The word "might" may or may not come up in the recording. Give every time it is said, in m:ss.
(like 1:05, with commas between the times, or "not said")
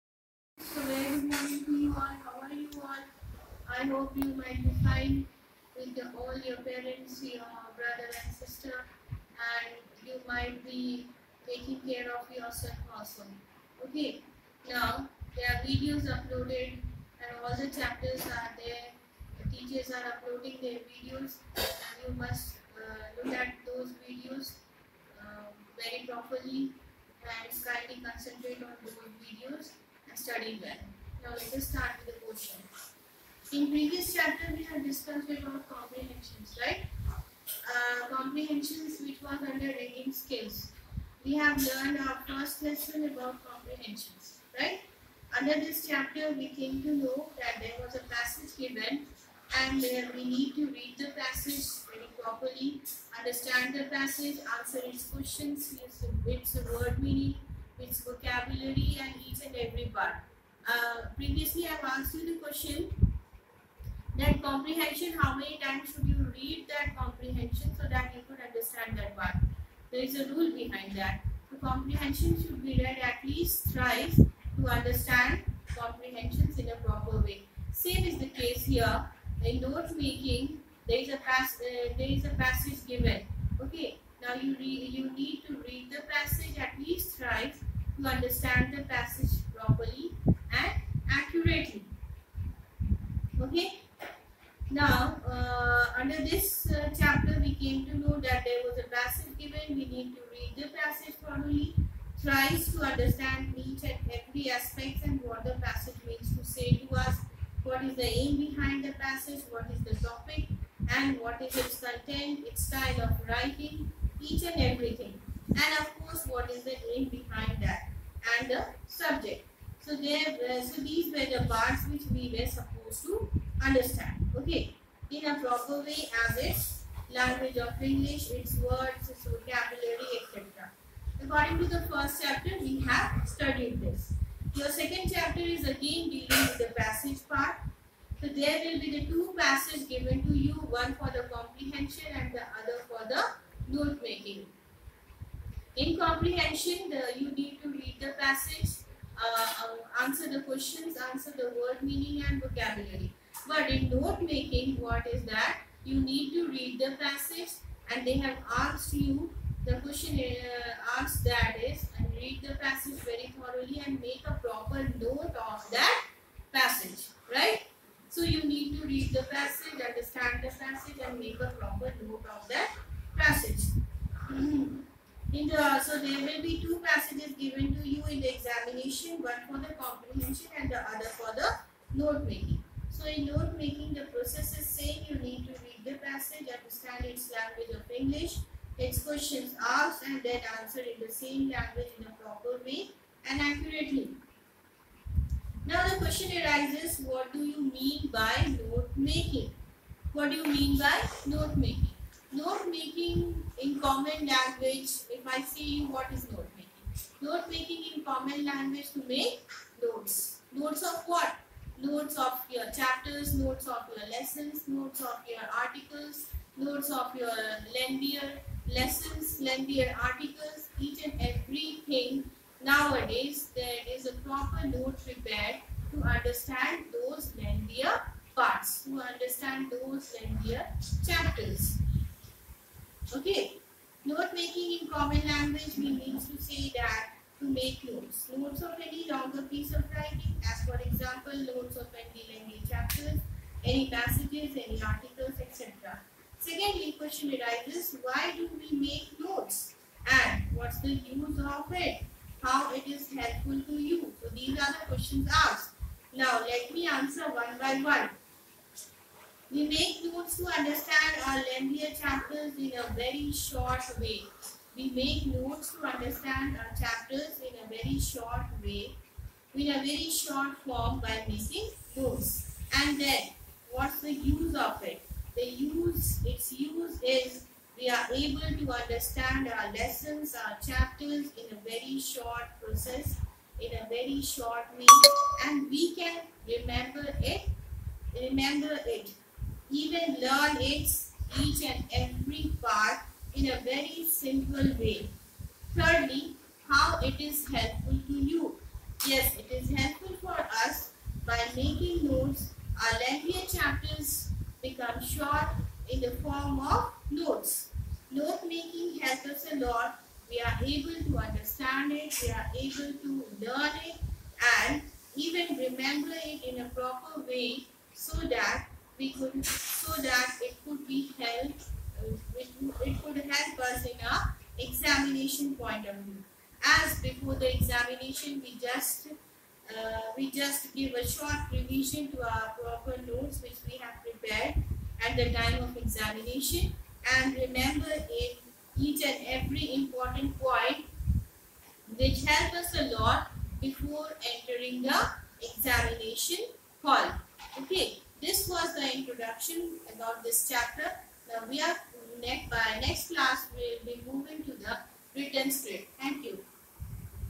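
0:04, 0:10.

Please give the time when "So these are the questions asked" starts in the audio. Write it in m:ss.
4:14.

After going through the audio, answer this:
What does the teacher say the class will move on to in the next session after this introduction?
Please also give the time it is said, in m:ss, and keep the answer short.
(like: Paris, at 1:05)
the written script, at 5:55.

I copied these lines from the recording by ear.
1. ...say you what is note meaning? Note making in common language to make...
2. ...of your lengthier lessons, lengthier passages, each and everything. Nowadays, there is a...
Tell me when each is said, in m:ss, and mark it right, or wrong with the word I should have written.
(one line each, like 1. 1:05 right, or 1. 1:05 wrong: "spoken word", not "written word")
1. 3:25 wrong: "making", not "meaning"
2. 3:36 wrong: "articles", not "passages".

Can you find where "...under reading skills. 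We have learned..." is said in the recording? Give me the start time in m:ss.
0:39.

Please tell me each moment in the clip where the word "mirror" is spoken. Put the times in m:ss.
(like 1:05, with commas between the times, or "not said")
not said.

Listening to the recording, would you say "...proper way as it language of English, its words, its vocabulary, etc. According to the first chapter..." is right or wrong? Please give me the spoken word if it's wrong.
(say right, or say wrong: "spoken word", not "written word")
right.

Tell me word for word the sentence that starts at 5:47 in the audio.
Okay, this was the introduction about this chapter.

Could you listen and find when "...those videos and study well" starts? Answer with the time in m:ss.
0:28.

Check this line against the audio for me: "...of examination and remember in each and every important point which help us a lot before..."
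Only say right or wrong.
right.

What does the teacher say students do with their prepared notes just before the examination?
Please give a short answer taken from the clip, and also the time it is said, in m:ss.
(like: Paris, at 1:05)
a short revision, at 5:31.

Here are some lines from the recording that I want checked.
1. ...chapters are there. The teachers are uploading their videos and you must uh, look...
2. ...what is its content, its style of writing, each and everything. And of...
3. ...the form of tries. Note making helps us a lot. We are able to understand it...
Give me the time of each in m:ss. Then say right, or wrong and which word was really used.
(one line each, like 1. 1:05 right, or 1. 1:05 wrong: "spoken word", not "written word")
1. 0:17 right
2. 1:51 right
3. 5:06 wrong: "notes", not "tries".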